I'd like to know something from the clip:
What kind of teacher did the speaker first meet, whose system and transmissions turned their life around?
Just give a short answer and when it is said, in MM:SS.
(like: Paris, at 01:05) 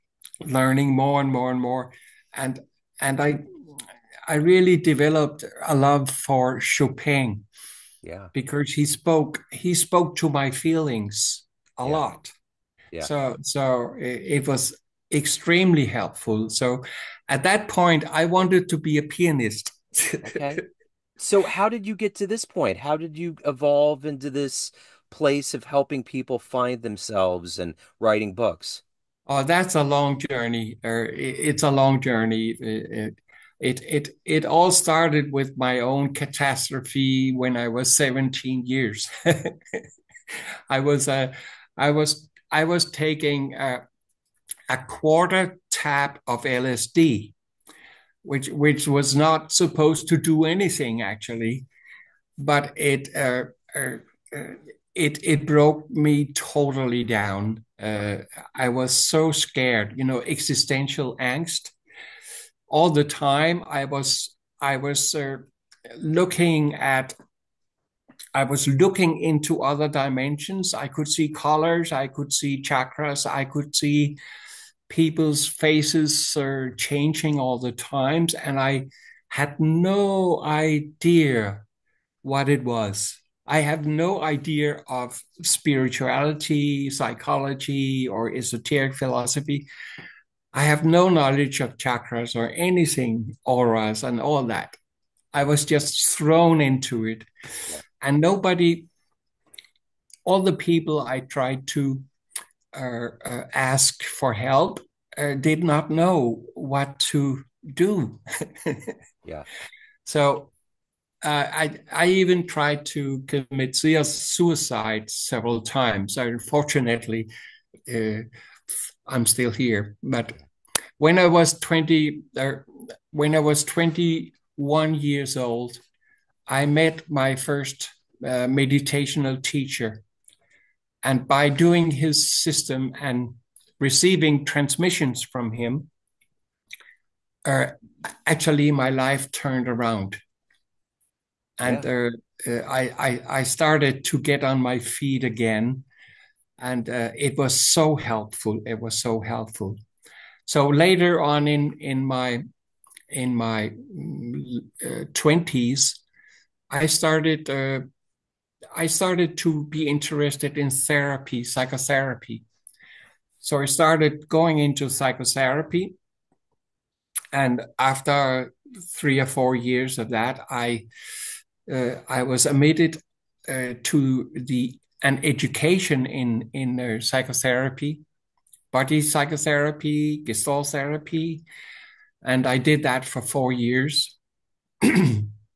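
Meditational teacher, at 02:08.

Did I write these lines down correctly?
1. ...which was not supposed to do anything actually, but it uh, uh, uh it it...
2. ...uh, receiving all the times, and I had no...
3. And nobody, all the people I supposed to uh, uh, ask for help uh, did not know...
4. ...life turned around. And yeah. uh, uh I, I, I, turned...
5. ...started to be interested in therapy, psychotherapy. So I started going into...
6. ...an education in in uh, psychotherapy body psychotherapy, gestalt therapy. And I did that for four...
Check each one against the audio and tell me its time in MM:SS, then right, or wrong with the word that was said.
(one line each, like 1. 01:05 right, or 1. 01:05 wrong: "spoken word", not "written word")
1. 00:48 right
2. 01:16 wrong: "changing", not "receiving"
3. 01:38 wrong: "tried", not "supposed"
4. 02:18 wrong: "started", not "turned"
5. 02:38 right
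6. 02:55 right.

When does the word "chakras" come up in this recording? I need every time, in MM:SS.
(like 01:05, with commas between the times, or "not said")
01:12, 01:31.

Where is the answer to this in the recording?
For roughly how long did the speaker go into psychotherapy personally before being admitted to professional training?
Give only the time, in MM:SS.
02:48.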